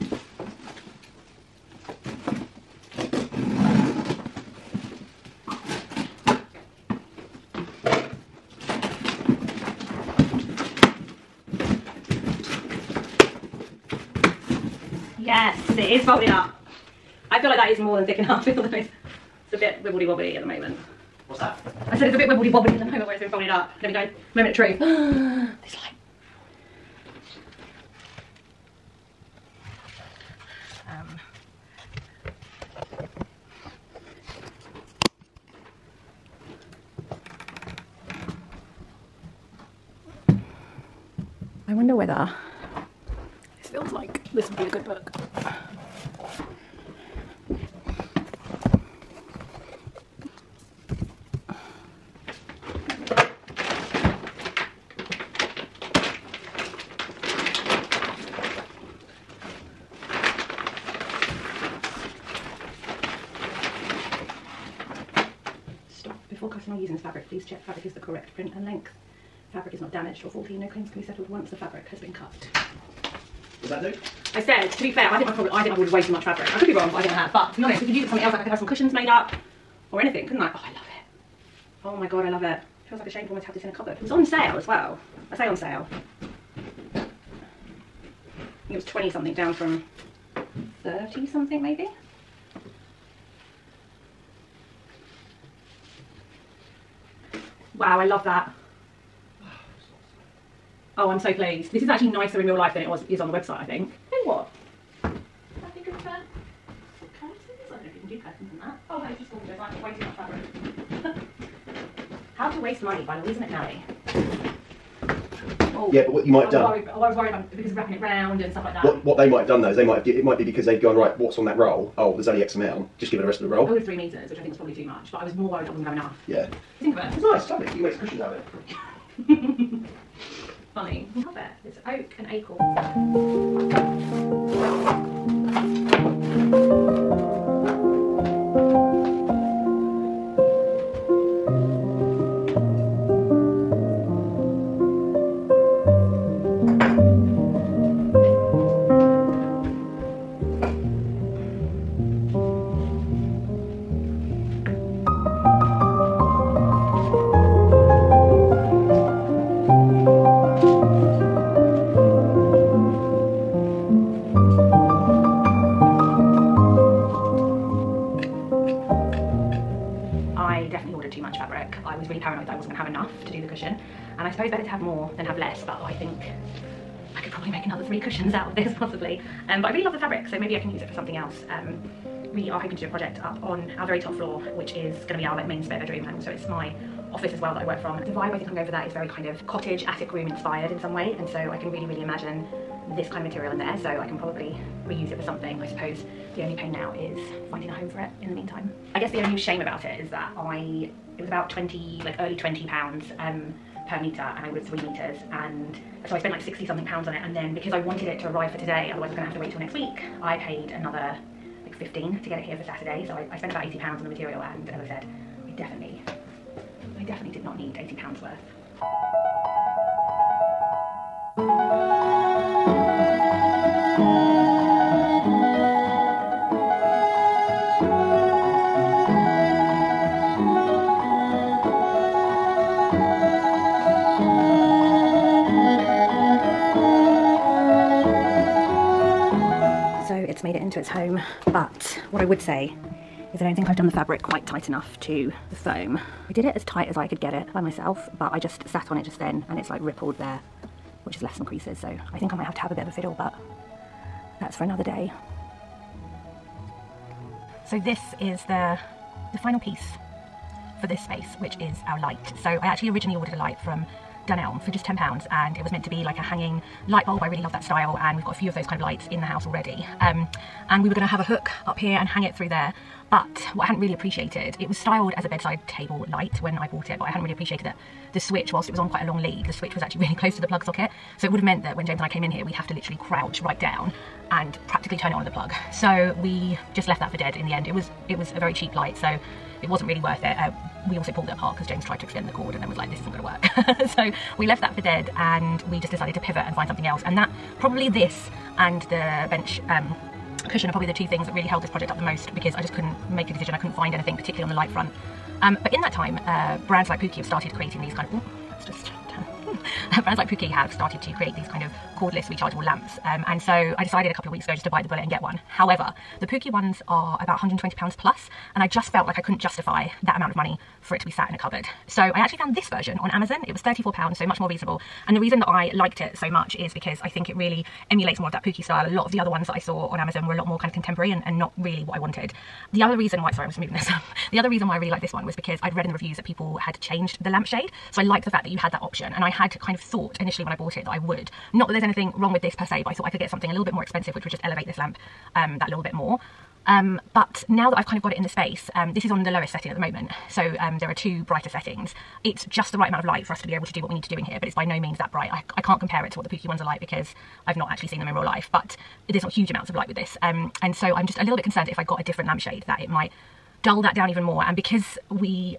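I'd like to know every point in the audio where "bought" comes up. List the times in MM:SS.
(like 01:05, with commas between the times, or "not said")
04:36, 05:40.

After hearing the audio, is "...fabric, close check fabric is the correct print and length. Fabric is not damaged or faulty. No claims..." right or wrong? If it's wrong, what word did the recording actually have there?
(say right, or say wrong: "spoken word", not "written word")
wrong: "please", not "close".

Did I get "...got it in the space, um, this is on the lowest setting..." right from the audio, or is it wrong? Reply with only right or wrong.
right.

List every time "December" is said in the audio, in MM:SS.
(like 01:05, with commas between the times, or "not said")
not said.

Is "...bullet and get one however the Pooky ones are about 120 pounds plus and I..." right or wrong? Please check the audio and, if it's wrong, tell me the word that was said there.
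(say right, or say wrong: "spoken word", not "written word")
right.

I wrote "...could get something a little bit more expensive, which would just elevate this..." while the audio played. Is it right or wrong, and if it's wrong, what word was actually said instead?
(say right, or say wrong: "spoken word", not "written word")
right.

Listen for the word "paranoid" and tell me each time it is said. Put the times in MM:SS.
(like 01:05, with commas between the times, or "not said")
02:52.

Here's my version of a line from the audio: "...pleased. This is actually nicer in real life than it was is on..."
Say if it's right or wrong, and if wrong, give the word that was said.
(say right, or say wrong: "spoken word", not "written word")
right.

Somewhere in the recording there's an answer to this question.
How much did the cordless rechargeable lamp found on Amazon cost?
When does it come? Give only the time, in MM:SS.
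05:23.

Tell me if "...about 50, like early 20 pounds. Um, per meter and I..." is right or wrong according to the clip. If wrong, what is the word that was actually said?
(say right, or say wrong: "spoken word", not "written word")
wrong: "20", not "50".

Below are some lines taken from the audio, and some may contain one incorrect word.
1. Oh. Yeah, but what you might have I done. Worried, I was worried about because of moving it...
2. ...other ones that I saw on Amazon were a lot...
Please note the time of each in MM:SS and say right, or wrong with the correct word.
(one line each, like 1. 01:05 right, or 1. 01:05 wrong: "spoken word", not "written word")
1. 01:55 wrong: "wrapping", not "moving"
2. 05:29 right.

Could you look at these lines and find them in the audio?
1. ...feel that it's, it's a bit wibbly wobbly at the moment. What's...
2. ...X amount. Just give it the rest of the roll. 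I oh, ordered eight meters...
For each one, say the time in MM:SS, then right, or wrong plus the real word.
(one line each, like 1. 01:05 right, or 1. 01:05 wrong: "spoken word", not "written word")
1. 00:18 right
2. 02:02 wrong: "three", not "eight".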